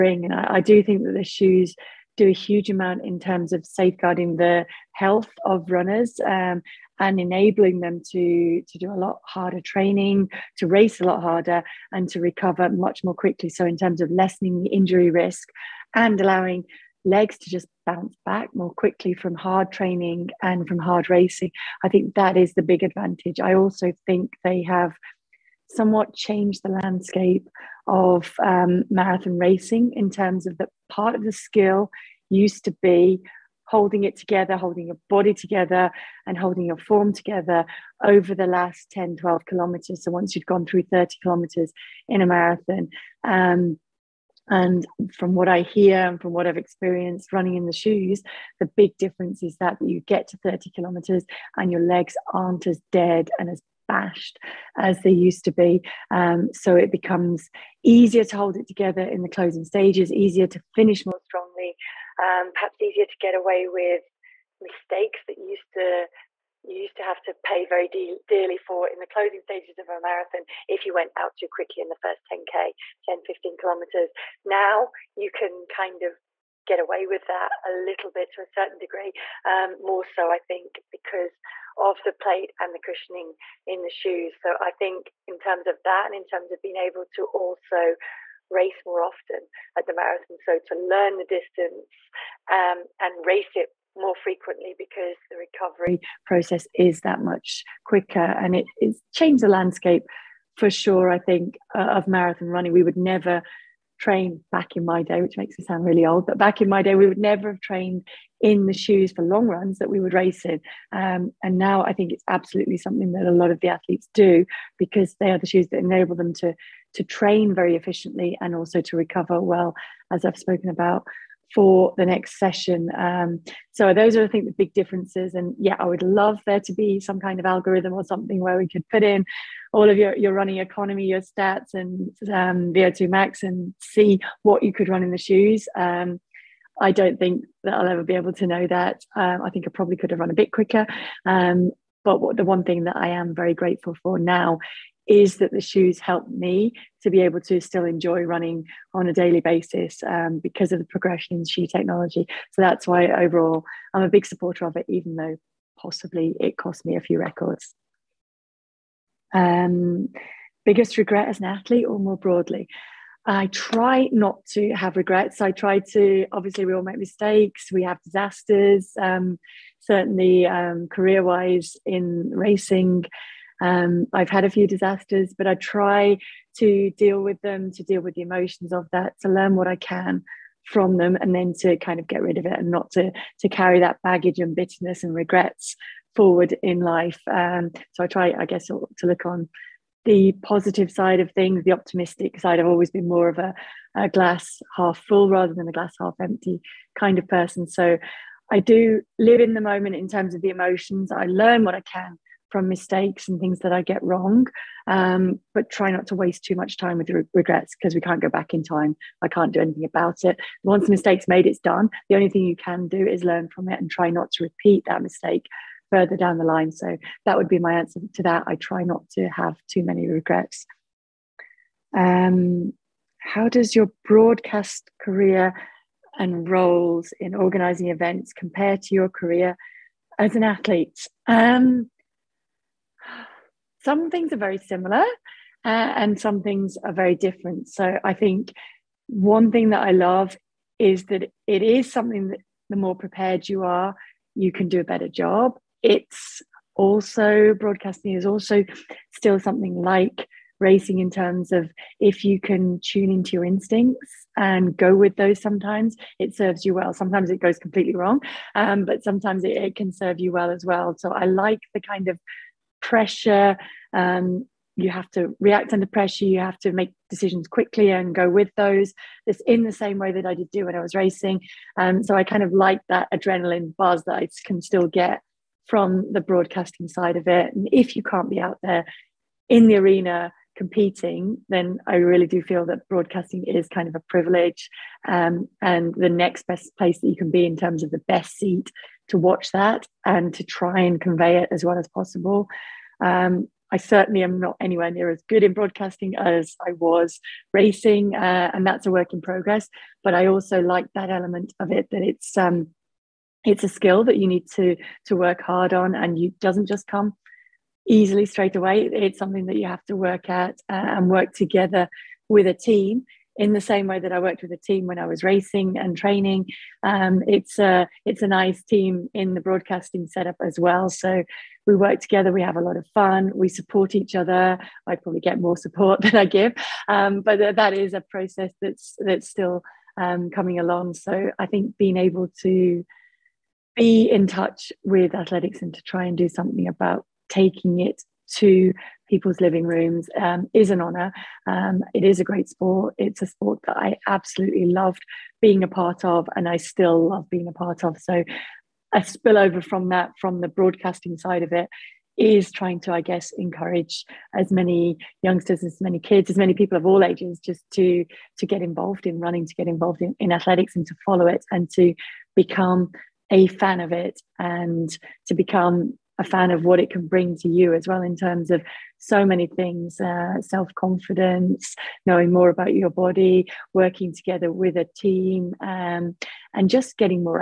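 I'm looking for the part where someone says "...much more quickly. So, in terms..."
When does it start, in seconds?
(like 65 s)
12 s.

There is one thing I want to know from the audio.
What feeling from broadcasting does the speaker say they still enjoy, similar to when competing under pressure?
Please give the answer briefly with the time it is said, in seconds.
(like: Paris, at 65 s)
adrenaline buzz, at 273 s.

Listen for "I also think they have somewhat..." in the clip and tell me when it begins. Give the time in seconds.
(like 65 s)
23 s.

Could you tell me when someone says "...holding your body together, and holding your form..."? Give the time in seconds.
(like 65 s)
34 s.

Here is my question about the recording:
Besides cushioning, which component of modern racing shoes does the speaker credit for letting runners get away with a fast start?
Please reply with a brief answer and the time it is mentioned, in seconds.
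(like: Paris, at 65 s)
the plate, at 82 s.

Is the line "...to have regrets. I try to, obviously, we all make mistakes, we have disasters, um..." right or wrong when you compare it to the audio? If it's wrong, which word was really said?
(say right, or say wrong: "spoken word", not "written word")
right.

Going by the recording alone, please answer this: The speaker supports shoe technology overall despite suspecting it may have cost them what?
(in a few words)
a few records.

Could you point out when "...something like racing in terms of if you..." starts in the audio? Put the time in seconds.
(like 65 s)
249 s.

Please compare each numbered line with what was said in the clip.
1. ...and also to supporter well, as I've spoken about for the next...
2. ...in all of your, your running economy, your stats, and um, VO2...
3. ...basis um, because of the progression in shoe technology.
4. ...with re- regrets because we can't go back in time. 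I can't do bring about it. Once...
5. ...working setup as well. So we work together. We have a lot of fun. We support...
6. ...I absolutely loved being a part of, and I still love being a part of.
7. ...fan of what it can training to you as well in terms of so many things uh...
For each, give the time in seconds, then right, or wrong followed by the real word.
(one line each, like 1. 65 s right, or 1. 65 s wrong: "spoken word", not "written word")
1. 118 s wrong: "recover", not "supporter"
2. 129 s right
3. 149 s right
4. 206 s wrong: "anything", not "bring"
5. 319 s wrong: "broadcasting", not "working"
6. 343 s right
7. 366 s wrong: "bring", not "training".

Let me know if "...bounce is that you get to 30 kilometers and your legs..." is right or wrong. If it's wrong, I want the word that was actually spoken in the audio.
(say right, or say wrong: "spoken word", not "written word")
wrong: "difference", not "bounce".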